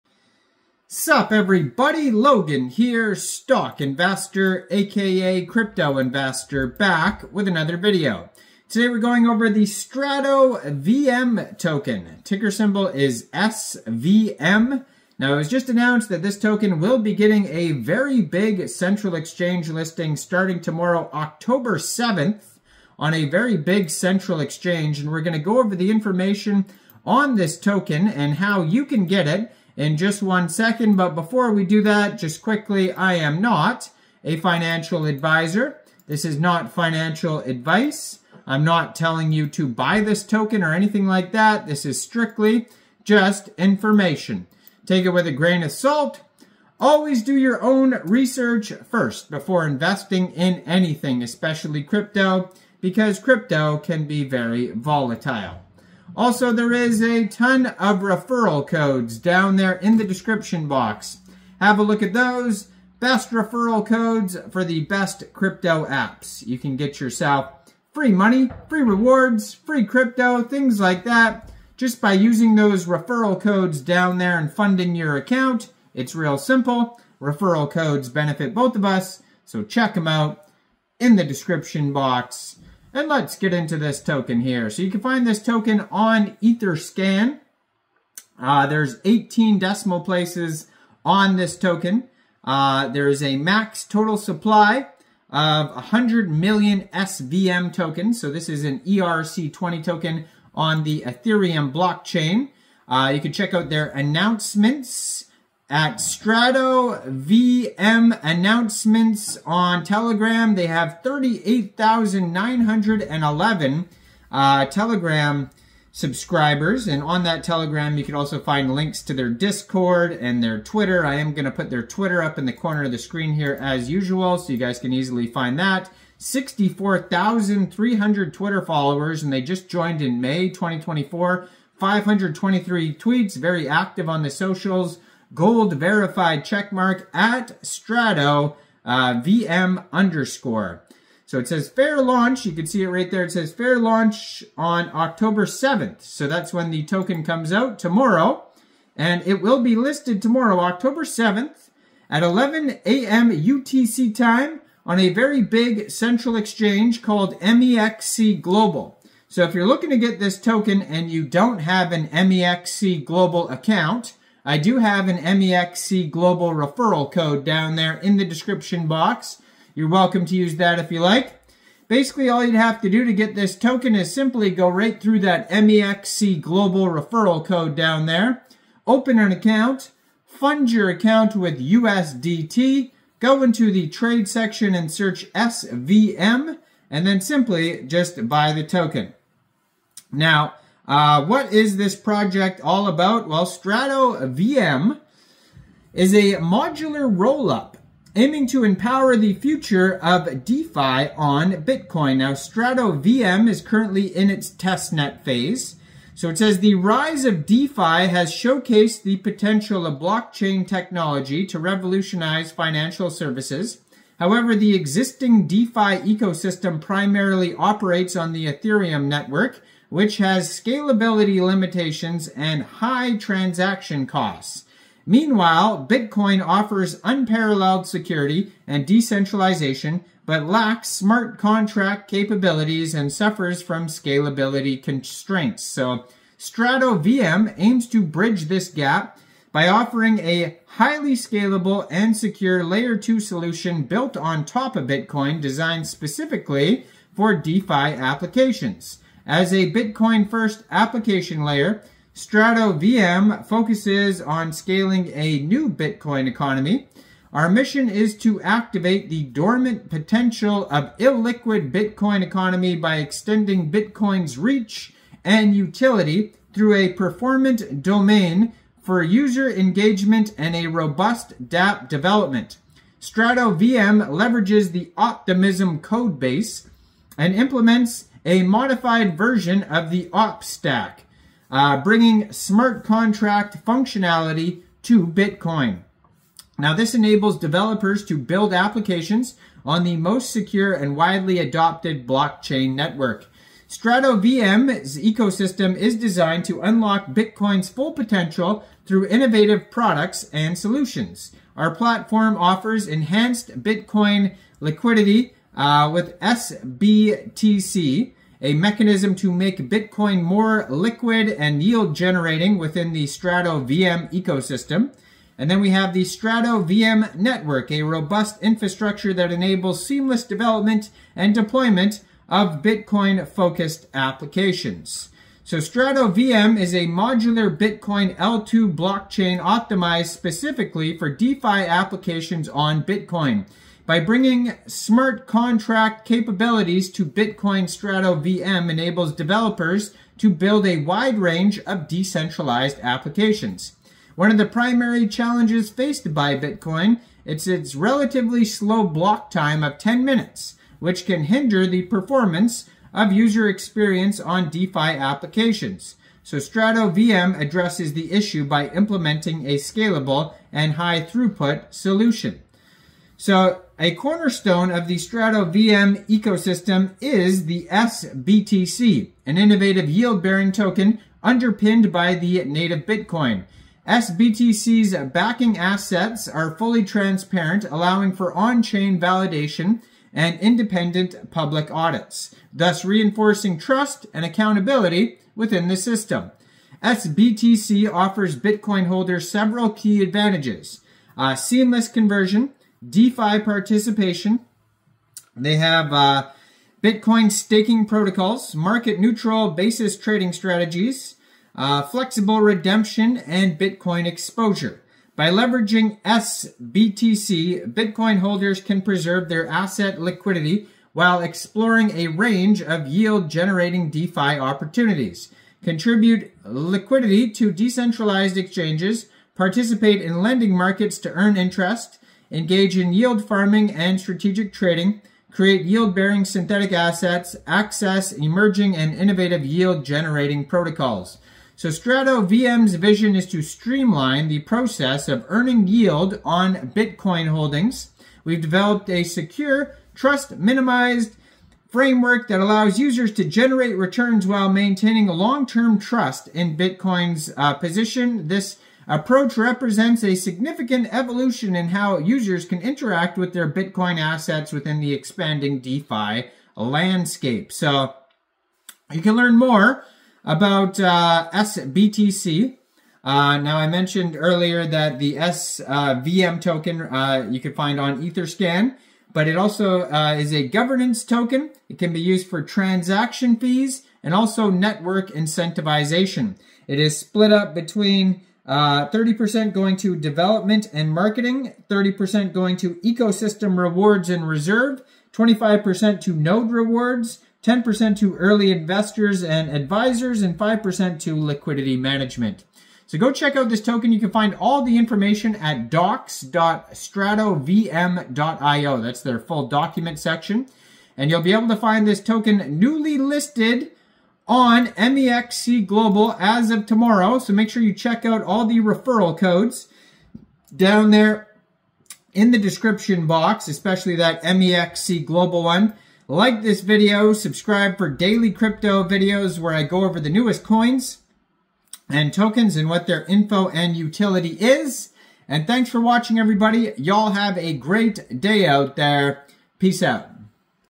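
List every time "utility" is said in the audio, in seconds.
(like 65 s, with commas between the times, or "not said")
265 s, 523 s.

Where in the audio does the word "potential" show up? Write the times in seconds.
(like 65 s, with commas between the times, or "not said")
209 s, 259 s, 297 s.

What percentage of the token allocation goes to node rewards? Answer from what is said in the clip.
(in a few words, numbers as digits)
25%.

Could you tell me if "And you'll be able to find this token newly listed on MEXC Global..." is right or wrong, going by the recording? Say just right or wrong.
right.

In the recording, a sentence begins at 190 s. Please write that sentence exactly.
Now, uh, what is this project all about?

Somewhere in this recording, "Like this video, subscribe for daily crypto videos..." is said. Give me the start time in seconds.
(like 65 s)
516 s.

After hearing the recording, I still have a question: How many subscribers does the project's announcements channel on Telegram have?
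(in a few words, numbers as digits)
38,911.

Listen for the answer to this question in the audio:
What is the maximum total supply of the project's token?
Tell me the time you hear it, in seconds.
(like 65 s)
95 s.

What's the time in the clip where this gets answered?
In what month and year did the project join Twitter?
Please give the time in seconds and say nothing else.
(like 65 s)
130 s.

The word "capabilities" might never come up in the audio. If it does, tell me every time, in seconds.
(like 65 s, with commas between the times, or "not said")
232 s, 336 s.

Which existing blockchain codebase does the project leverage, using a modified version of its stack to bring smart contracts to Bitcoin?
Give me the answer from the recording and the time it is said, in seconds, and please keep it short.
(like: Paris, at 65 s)
Optimism, at 274 s.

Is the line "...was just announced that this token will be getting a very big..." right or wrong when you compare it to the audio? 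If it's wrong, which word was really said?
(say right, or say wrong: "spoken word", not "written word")
right.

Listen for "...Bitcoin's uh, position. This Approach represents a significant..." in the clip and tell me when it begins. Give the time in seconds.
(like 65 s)
446 s.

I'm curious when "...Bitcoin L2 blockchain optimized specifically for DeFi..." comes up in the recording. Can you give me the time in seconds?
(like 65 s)
327 s.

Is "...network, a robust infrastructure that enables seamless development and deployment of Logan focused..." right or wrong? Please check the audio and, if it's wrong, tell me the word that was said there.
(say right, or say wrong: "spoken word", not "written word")
wrong: "Bitcoin", not "Logan".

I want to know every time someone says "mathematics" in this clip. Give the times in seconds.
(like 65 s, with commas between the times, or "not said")
not said.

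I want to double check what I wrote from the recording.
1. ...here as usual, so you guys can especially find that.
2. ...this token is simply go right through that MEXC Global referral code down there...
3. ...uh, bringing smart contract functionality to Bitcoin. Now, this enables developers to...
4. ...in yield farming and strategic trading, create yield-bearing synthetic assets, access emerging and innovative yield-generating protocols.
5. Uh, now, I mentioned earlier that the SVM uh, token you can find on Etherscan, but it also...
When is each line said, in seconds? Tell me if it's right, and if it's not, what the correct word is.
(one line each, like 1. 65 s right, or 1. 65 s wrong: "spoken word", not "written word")
1. 123 s wrong: "easily", not "especially"
2. 173 s right
3. 281 s right
4. 422 s right
5. 463 s right.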